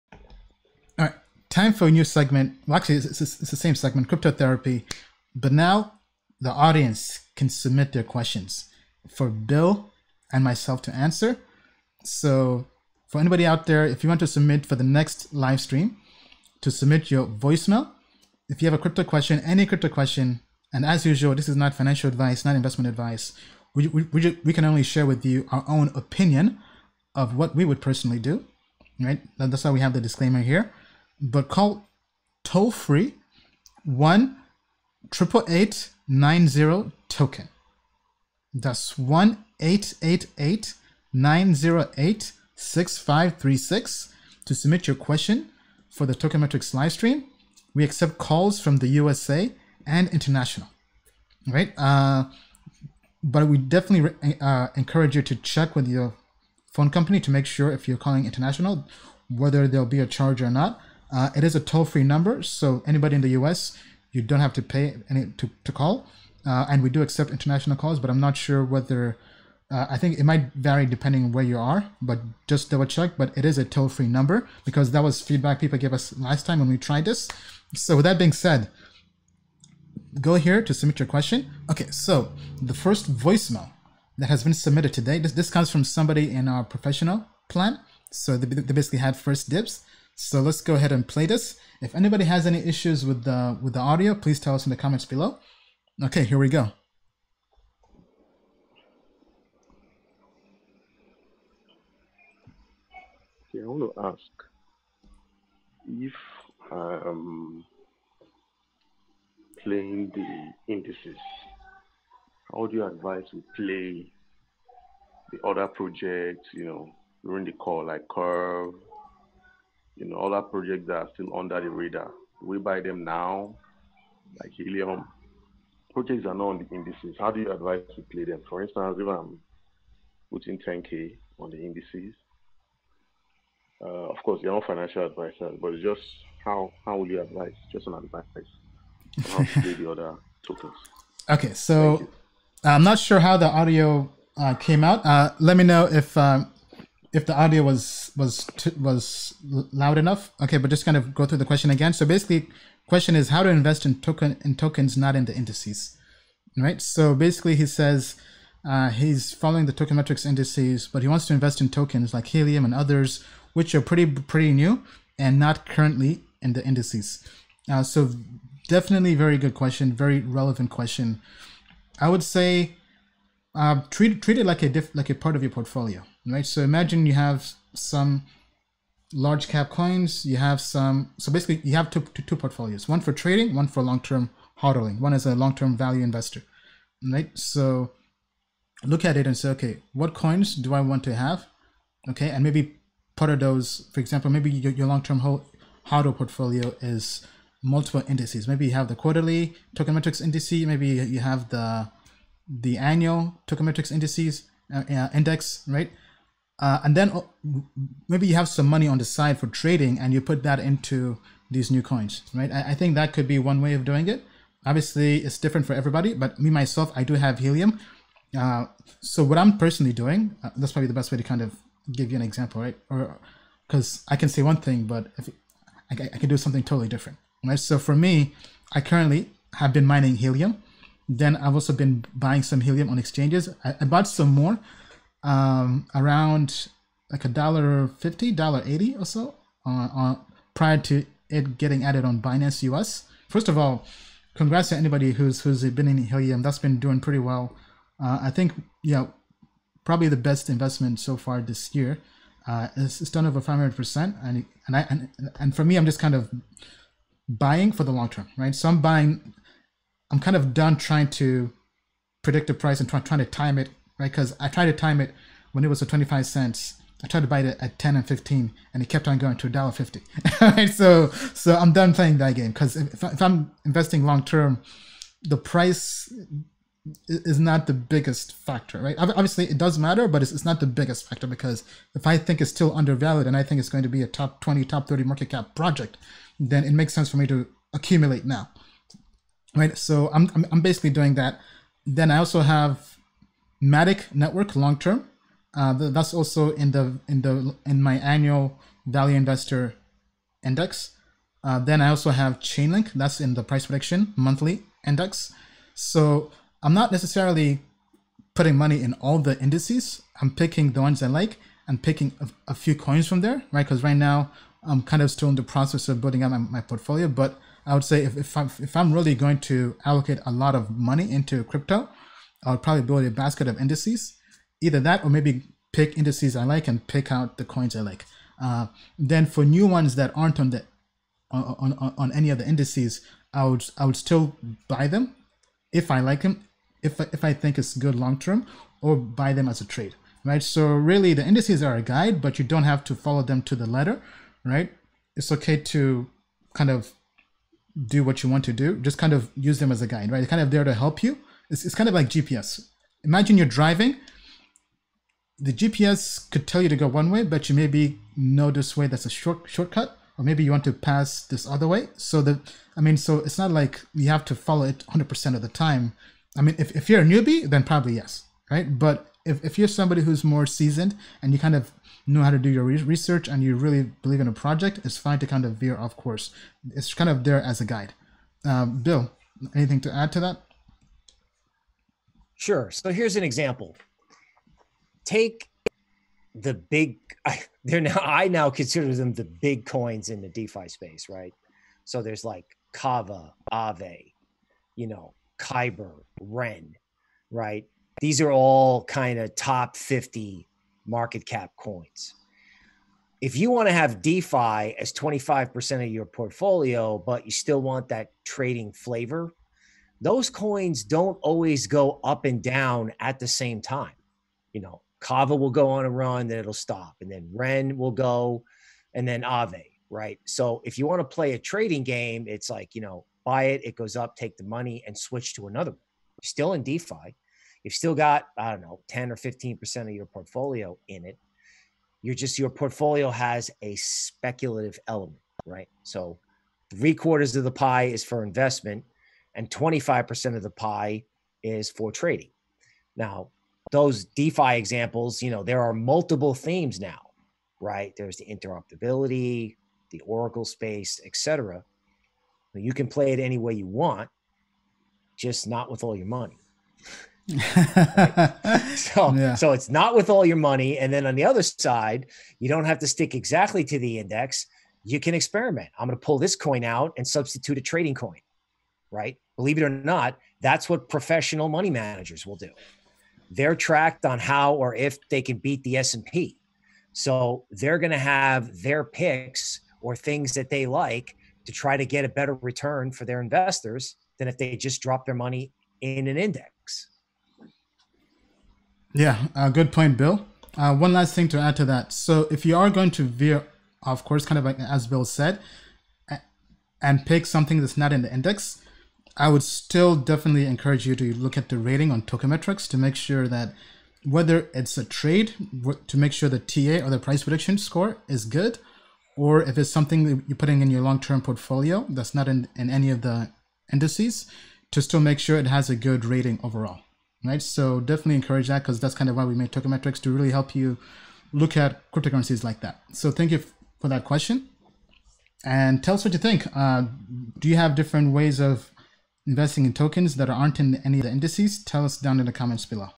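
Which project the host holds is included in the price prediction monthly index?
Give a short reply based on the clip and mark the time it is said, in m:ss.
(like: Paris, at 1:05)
Chainlink, at 5:02.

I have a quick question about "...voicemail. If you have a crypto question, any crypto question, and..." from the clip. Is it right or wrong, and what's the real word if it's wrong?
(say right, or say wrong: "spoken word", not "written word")
right.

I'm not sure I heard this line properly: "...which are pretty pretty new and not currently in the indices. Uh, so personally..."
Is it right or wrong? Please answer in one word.
wrong.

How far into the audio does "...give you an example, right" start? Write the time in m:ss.
3:41.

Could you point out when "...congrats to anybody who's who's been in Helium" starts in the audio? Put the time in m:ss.
4:04.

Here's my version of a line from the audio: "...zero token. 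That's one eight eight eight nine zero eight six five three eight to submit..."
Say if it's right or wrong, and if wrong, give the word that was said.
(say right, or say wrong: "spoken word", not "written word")
wrong: "six", not "eight".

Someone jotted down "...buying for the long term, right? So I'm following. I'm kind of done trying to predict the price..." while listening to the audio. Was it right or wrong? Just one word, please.
wrong.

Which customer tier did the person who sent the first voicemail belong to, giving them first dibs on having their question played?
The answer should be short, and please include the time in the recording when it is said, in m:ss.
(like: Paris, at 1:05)
professional plan, at 1:26.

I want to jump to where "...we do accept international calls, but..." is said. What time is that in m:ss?
1:06.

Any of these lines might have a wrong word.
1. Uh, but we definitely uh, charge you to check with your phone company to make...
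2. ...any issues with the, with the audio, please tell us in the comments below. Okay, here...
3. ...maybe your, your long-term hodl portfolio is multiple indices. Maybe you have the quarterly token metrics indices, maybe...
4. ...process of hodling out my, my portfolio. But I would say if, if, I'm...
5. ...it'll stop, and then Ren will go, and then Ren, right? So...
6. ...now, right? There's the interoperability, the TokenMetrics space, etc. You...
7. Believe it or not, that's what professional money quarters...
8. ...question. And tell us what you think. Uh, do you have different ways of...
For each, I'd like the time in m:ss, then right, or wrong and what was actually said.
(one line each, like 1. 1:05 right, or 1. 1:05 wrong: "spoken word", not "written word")
1. 0:51 wrong: "encourage", not "charge"
2. 1:32 right
3. 3:14 right
4. 5:15 wrong: "building", not "hodling"
5. 6:56 wrong: "Aave", not "Ren"
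6. 7:26 wrong: "Oracle", not "TokenMetrics"
7. 7:49 wrong: "managers", not "quarters"
8. 8:44 right.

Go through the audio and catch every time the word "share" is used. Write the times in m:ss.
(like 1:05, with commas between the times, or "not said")
0:24.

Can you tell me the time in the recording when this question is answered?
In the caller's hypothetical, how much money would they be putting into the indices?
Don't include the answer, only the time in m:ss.
2:10.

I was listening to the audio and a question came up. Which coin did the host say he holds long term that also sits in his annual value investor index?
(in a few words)
Matic network.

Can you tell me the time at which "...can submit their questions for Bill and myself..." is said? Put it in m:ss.
0:07.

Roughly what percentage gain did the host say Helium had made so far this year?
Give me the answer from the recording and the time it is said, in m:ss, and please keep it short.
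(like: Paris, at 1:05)
500%, at 4:13.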